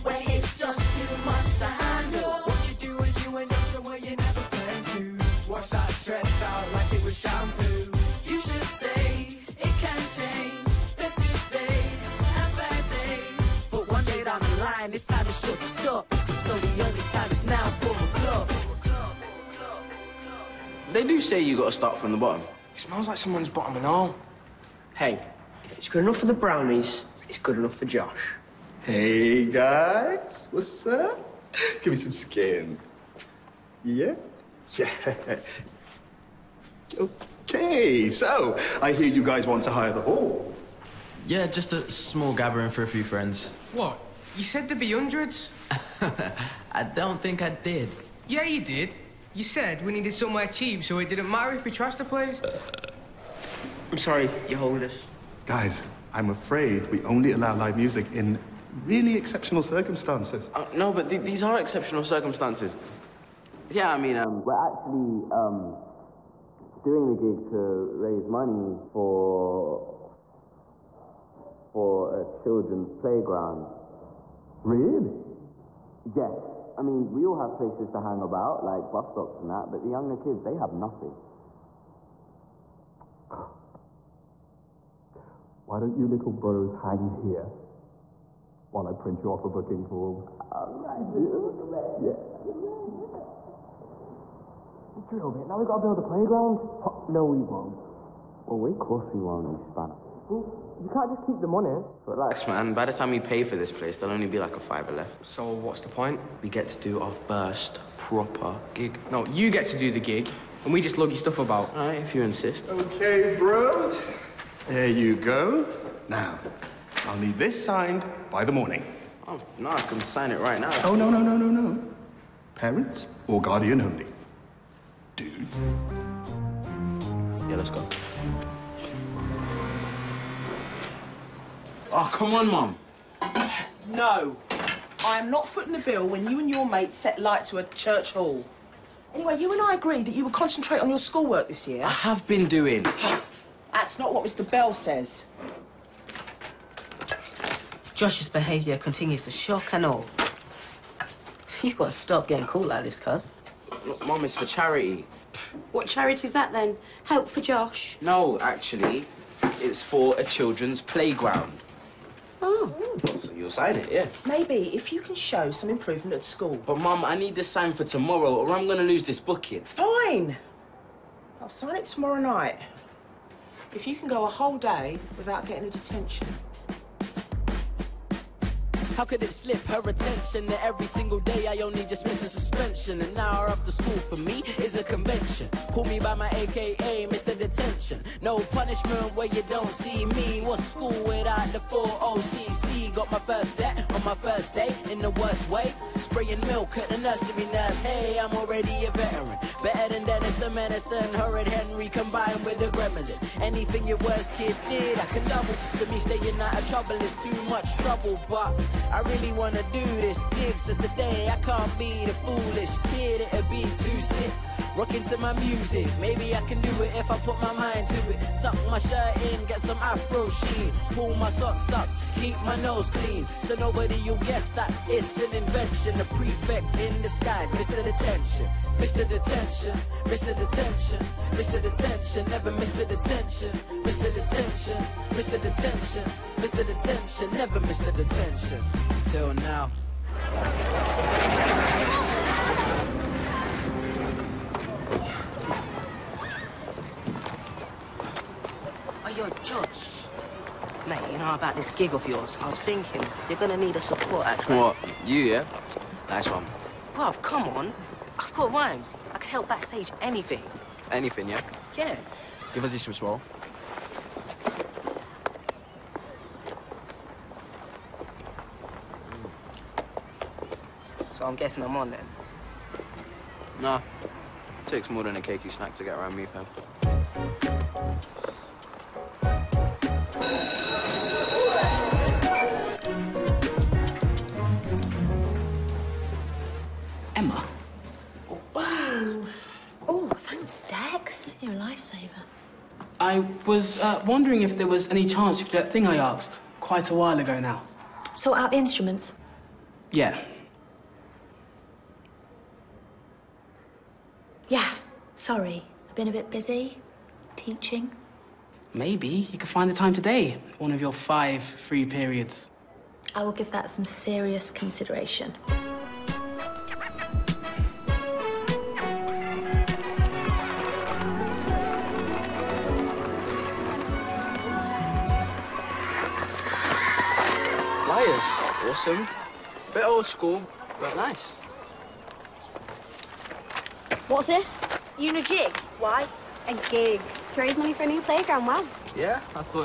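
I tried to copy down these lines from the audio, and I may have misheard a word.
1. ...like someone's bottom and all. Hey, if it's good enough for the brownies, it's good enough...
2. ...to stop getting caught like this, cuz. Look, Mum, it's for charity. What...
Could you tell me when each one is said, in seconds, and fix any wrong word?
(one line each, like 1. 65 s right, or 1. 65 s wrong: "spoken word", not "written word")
1. 23 s right
2. 151 s right.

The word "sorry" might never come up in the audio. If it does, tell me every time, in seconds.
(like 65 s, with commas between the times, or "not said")
53 s, 305 s.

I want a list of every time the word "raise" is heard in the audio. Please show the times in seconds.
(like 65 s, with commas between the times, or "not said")
68 s, 337 s.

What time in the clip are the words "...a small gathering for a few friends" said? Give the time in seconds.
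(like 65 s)
41 s.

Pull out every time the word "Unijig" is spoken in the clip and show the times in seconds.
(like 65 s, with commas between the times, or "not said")
334 s.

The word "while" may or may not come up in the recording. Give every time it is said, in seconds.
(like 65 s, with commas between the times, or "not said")
88 s, 296 s.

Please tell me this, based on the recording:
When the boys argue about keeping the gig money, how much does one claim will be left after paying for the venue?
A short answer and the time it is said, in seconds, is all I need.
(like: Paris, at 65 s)
a fiver, at 104 s.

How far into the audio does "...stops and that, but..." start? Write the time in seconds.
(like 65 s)
79 s.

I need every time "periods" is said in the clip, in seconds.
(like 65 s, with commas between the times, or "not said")
311 s.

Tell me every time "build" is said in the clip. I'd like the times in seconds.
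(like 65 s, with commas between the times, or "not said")
95 s.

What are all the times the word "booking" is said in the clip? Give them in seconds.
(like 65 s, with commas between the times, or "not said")
89 s, 169 s.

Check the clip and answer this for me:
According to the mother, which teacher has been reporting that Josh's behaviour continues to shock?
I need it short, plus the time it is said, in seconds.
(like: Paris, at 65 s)
Mr Bell, at 144 s.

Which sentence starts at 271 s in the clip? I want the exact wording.
So I'm guessing I'm on then?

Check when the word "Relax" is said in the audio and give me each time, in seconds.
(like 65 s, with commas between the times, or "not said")
102 s.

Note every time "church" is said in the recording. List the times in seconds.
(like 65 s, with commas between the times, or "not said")
137 s.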